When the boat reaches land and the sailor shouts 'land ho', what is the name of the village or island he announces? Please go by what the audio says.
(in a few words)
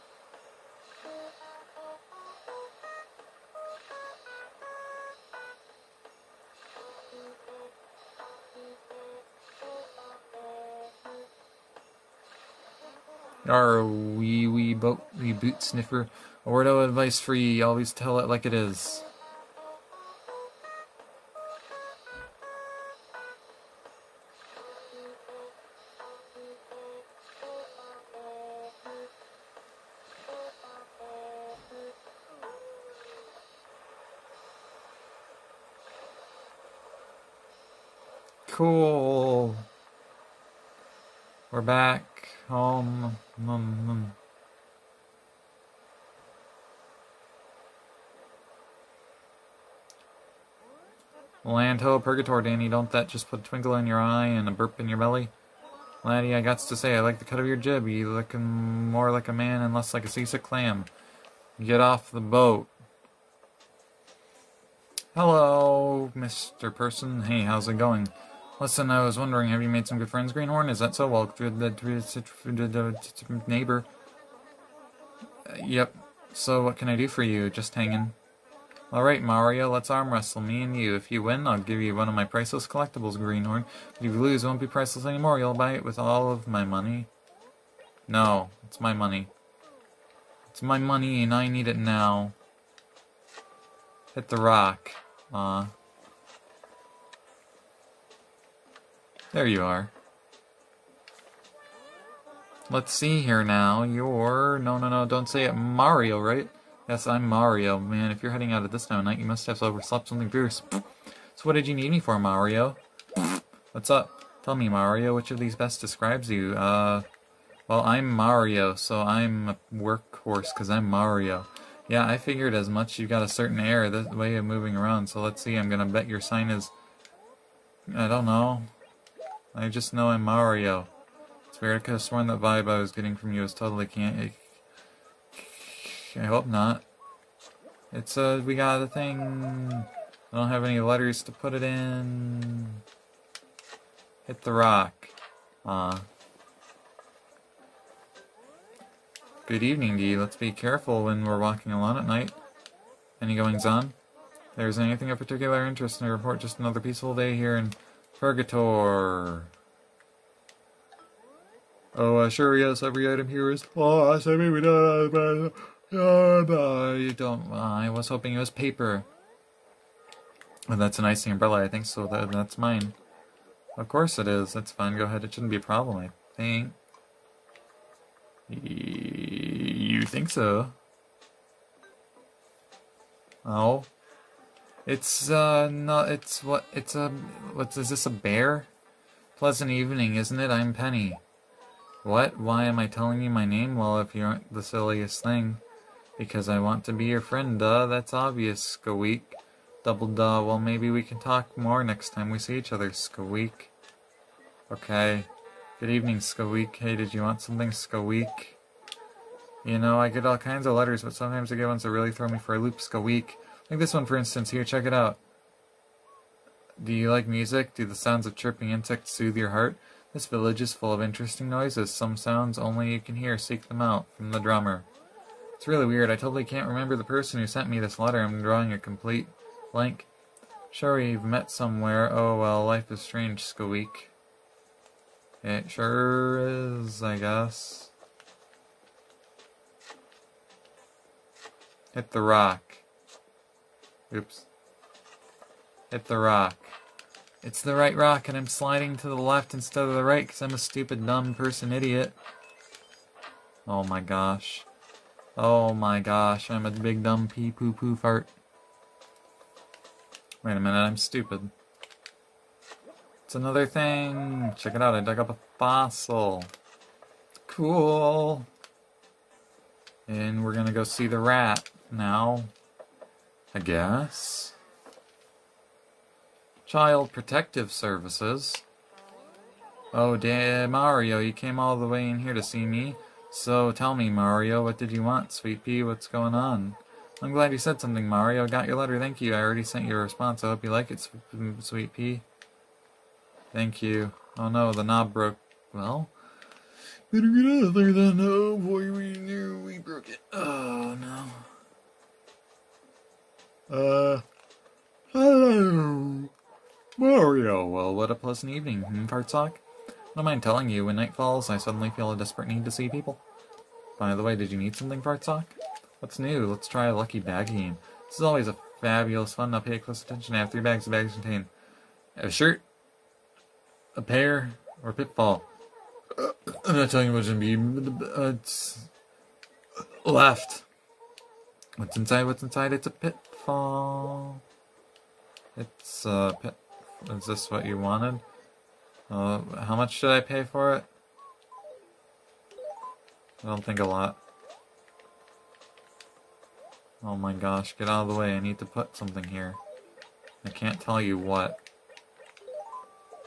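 Purgatory.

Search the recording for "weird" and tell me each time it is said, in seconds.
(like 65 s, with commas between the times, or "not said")
131 s, 225 s.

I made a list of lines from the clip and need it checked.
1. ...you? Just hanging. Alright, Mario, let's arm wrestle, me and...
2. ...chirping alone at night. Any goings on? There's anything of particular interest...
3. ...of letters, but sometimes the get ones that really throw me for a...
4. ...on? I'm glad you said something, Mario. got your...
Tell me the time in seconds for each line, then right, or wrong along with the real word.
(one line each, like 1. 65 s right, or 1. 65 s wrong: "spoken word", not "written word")
1. 77 s right
2. 151 s wrong: "walking", not "chirping"
3. 210 s right
4. 286 s right.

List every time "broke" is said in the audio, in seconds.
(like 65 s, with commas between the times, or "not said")
295 s, 299 s.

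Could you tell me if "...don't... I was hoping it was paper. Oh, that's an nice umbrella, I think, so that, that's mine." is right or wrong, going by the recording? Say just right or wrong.
right.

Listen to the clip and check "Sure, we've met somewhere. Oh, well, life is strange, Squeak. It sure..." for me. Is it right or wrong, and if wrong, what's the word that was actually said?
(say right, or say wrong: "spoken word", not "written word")
right.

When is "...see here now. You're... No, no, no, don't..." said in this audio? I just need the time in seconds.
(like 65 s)
102 s.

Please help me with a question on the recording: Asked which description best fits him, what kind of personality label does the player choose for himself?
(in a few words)
workhorse.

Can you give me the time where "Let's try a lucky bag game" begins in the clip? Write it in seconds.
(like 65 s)
316 s.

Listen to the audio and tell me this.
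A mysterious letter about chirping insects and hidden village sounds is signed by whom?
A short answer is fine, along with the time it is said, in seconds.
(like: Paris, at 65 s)
the drummer, at 224 s.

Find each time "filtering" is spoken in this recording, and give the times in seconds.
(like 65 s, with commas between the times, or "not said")
not said.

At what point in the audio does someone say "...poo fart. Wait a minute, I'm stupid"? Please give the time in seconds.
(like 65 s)
257 s.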